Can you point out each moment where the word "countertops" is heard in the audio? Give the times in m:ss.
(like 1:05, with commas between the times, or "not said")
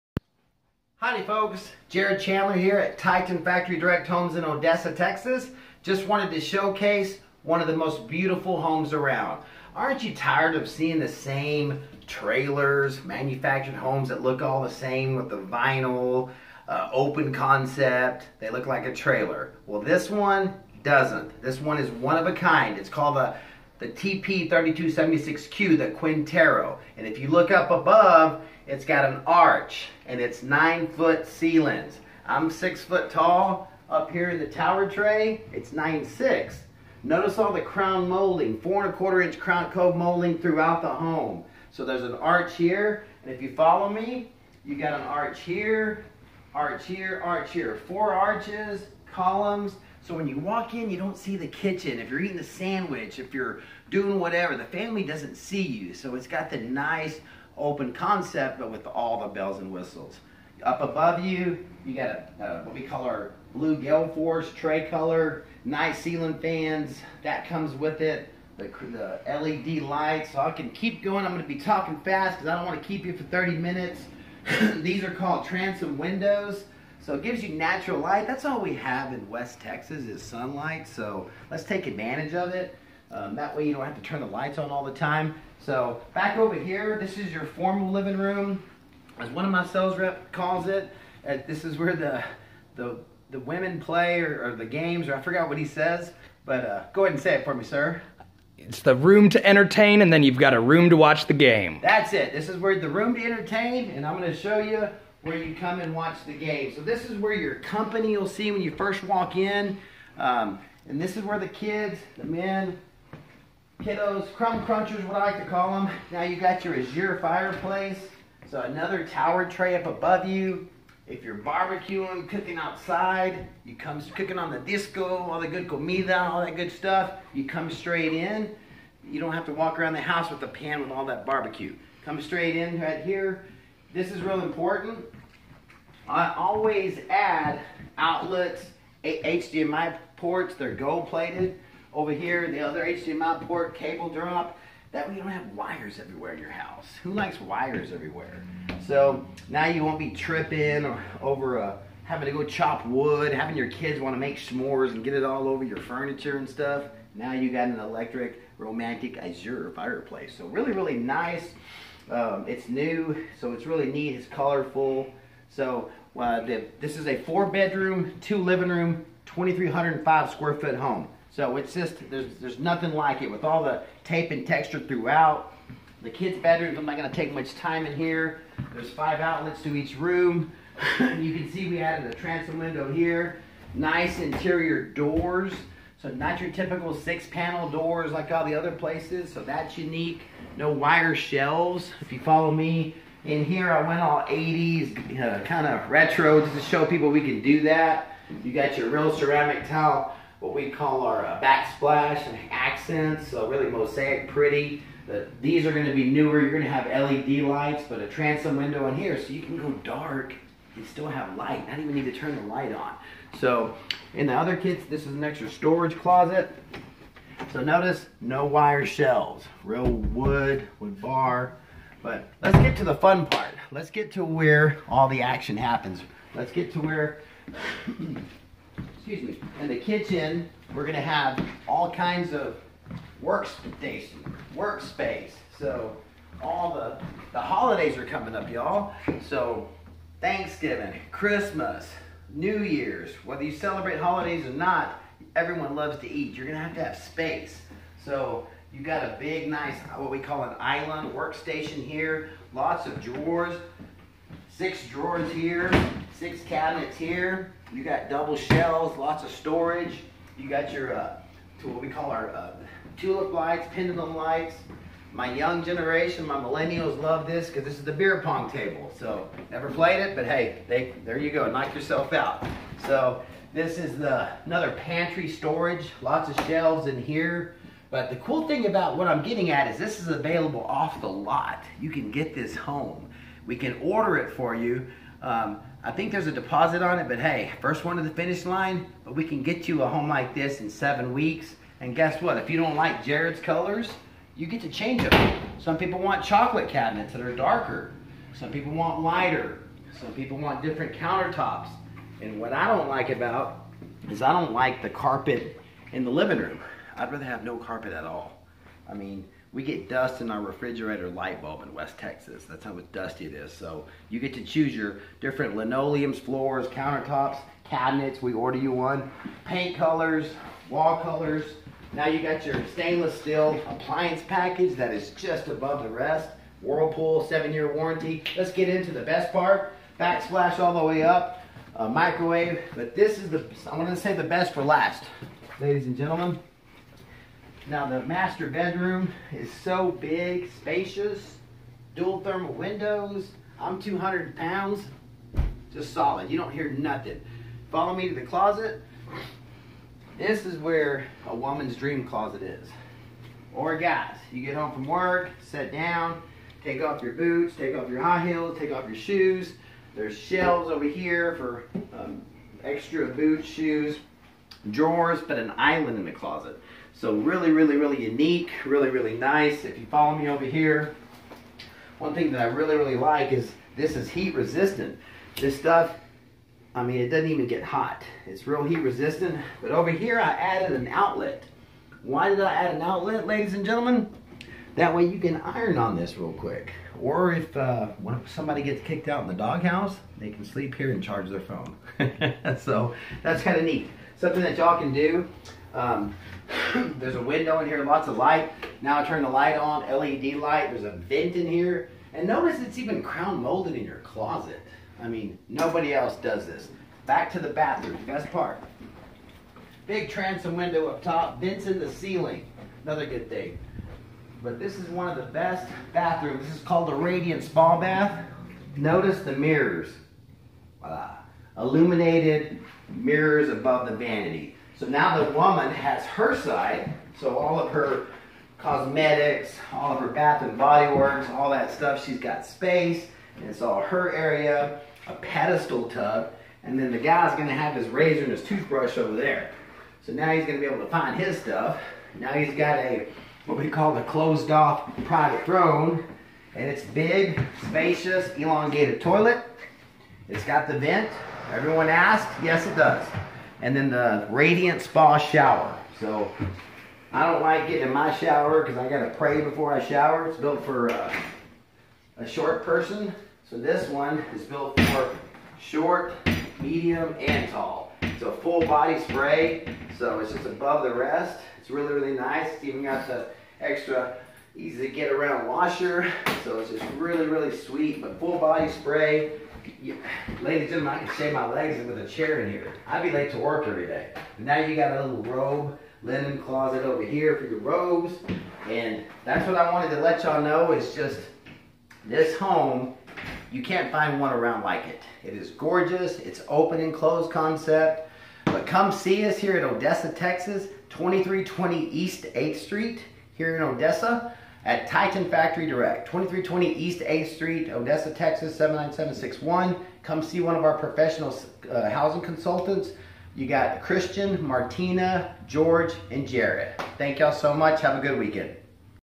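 5:00, 5:16.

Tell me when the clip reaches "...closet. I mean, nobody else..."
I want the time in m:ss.
6:43.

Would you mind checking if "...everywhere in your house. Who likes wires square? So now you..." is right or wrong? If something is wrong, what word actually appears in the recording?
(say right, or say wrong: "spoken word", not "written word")
wrong: "everywhere", not "square".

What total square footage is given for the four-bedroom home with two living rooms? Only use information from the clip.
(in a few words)
2,305.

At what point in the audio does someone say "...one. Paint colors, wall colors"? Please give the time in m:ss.
5:18.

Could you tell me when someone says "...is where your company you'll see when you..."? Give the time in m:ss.
1:47.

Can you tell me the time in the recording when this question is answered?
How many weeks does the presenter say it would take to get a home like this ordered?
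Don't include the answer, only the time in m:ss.
4:50.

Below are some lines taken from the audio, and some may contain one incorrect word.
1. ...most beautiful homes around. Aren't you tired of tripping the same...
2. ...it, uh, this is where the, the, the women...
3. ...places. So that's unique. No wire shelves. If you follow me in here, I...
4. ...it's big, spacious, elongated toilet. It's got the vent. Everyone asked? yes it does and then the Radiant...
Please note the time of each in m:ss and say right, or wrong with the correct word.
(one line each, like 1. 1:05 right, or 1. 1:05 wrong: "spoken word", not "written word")
1. 0:07 wrong: "seeing", not "tripping"
2. 1:30 right
3. 3:08 right
4. 7:26 right.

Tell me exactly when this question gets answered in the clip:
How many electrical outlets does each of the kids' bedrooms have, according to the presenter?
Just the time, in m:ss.
2:58.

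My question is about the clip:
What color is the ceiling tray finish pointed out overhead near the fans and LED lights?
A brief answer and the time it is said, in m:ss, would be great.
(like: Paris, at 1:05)
blue gale force, at 1:03.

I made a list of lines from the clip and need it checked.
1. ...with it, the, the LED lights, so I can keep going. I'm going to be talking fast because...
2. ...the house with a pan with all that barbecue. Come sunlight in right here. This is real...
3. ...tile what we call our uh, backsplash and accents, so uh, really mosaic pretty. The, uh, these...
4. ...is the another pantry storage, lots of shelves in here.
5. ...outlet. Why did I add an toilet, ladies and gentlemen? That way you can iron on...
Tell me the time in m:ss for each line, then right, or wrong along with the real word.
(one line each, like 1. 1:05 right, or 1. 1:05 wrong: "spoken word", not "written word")
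1. 1:07 right
2. 2:09 wrong: "straight", not "sunlight"
3. 3:19 right
4. 4:33 right
5. 6:20 wrong: "outlet", not "toilet".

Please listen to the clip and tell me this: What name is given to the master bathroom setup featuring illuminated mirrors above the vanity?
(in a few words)
Radiant Spa Bath.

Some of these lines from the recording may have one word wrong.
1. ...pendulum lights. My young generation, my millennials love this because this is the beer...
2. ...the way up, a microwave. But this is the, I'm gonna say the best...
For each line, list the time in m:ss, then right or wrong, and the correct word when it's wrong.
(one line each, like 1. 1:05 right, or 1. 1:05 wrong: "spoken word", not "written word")
1. 4:23 right
2. 5:30 right.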